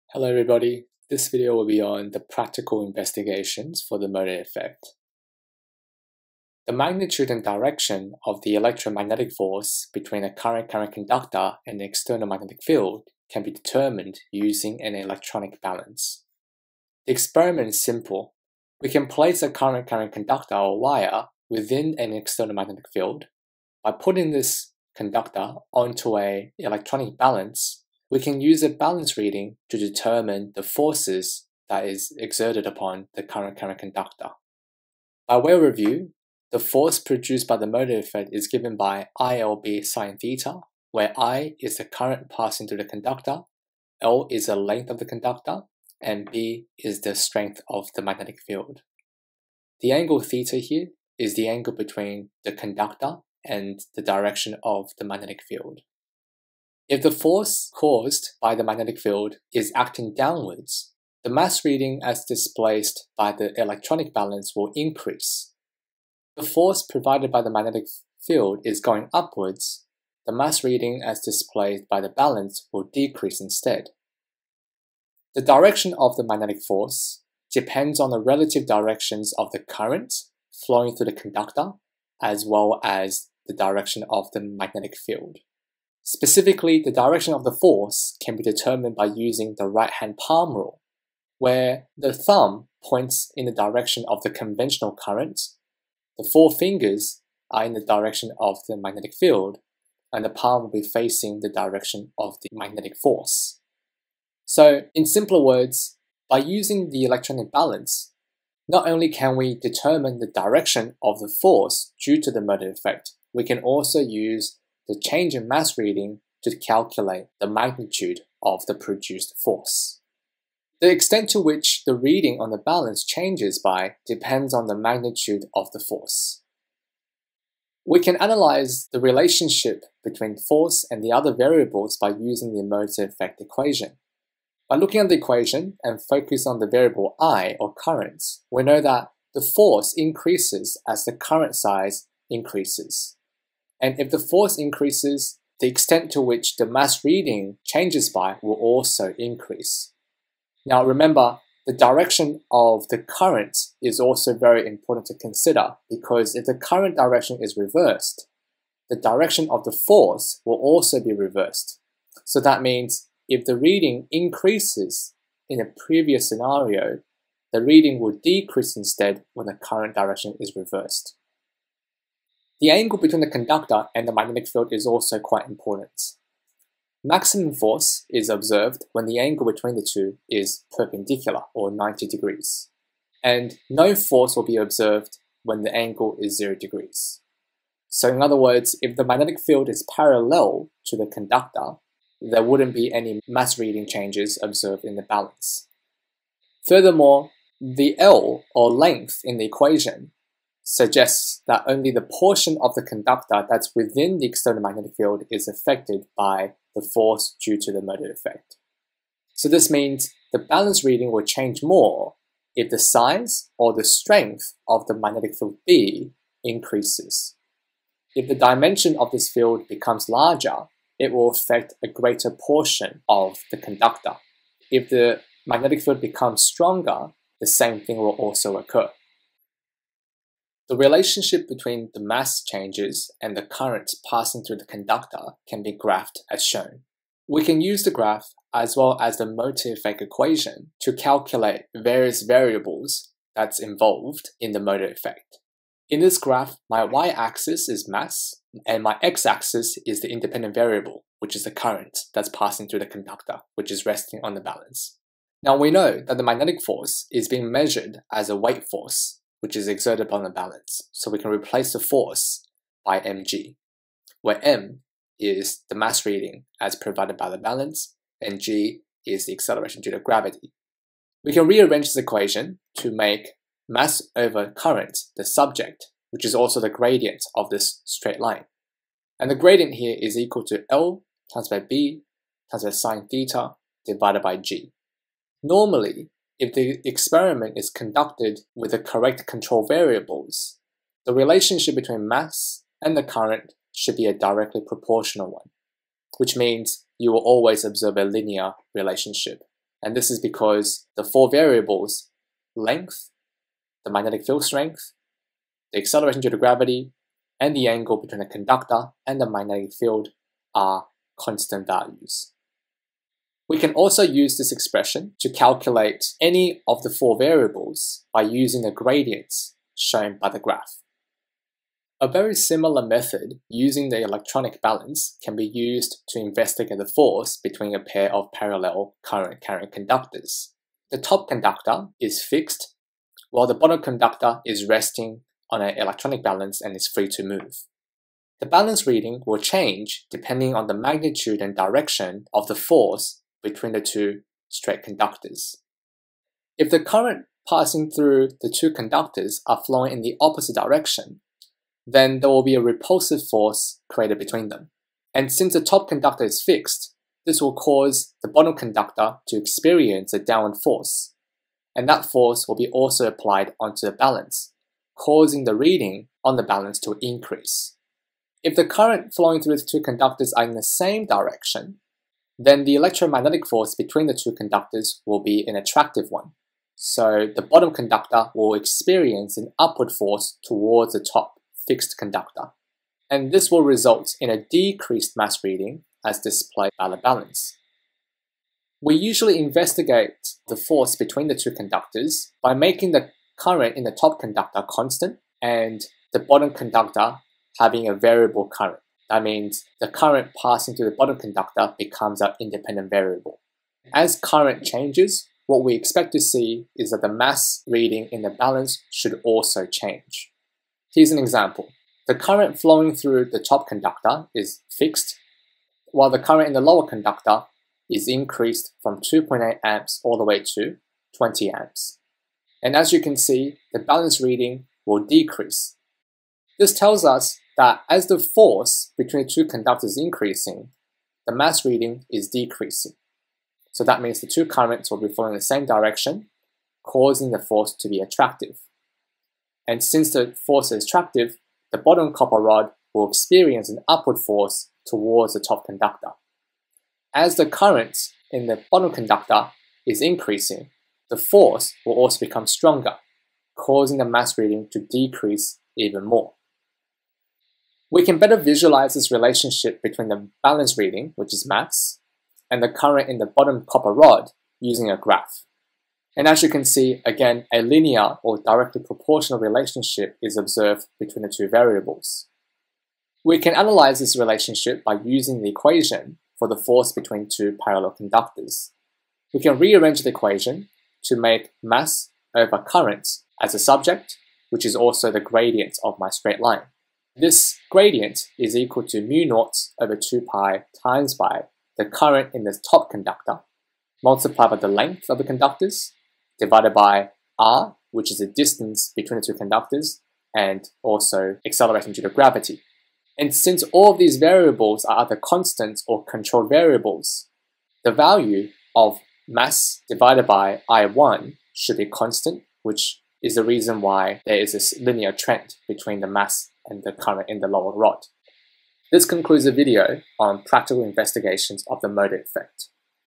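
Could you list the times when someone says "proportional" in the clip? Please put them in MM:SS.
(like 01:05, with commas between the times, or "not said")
04:54, 07:48.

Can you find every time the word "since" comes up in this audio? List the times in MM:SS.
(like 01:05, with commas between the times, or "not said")
05:55, 07:19, 08:23.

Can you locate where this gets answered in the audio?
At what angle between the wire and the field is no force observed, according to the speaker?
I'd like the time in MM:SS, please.
03:06.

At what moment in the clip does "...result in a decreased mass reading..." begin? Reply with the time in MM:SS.
06:23.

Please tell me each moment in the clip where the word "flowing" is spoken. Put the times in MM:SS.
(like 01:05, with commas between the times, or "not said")
01:20, 05:49, 06:09, 06:52, 07:15.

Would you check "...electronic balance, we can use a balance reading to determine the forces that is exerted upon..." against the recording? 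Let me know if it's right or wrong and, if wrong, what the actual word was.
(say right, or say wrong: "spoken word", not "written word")
right.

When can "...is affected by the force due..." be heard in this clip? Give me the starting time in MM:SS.
03:25.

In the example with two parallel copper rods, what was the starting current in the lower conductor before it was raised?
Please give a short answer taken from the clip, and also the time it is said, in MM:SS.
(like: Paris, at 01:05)
2.8 amps, at 06:59.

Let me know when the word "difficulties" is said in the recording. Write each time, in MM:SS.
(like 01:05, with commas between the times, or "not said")
not said.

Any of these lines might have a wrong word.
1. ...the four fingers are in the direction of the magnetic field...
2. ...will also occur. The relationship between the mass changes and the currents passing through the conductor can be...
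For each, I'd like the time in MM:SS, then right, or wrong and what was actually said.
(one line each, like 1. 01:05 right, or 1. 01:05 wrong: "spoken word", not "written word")
1. 01:36 right
2. 03:47 right.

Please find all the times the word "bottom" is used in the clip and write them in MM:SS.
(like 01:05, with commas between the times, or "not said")
05:33, 05:58, 06:17, 06:36, 06:40, 07:21, 07:28, 07:43.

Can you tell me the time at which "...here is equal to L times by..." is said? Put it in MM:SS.
04:39.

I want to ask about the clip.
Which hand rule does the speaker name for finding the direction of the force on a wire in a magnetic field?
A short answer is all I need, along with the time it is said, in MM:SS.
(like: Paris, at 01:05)
Right hand palm rule, at 01:29.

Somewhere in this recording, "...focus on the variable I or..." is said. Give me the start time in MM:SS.
02:16.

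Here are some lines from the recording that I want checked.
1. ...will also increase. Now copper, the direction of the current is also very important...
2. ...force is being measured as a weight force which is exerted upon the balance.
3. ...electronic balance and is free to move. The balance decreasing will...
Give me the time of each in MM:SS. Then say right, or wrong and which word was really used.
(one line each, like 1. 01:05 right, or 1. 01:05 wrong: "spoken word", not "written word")
1. 02:28 wrong: "remember", not "copper"
2. 04:16 right
3. 05:35 wrong: "reading", not "decreasing".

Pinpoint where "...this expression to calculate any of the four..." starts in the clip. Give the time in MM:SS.
05:14.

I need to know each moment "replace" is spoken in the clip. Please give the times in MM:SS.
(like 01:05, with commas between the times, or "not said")
04:21.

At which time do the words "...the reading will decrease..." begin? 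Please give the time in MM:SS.
02:47.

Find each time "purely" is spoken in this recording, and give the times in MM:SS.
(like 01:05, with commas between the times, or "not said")
not said.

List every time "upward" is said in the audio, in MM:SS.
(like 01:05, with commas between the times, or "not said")
01:09, 06:19, 07:23.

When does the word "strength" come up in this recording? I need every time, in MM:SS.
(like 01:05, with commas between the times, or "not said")
00:47, 03:33, 05:04.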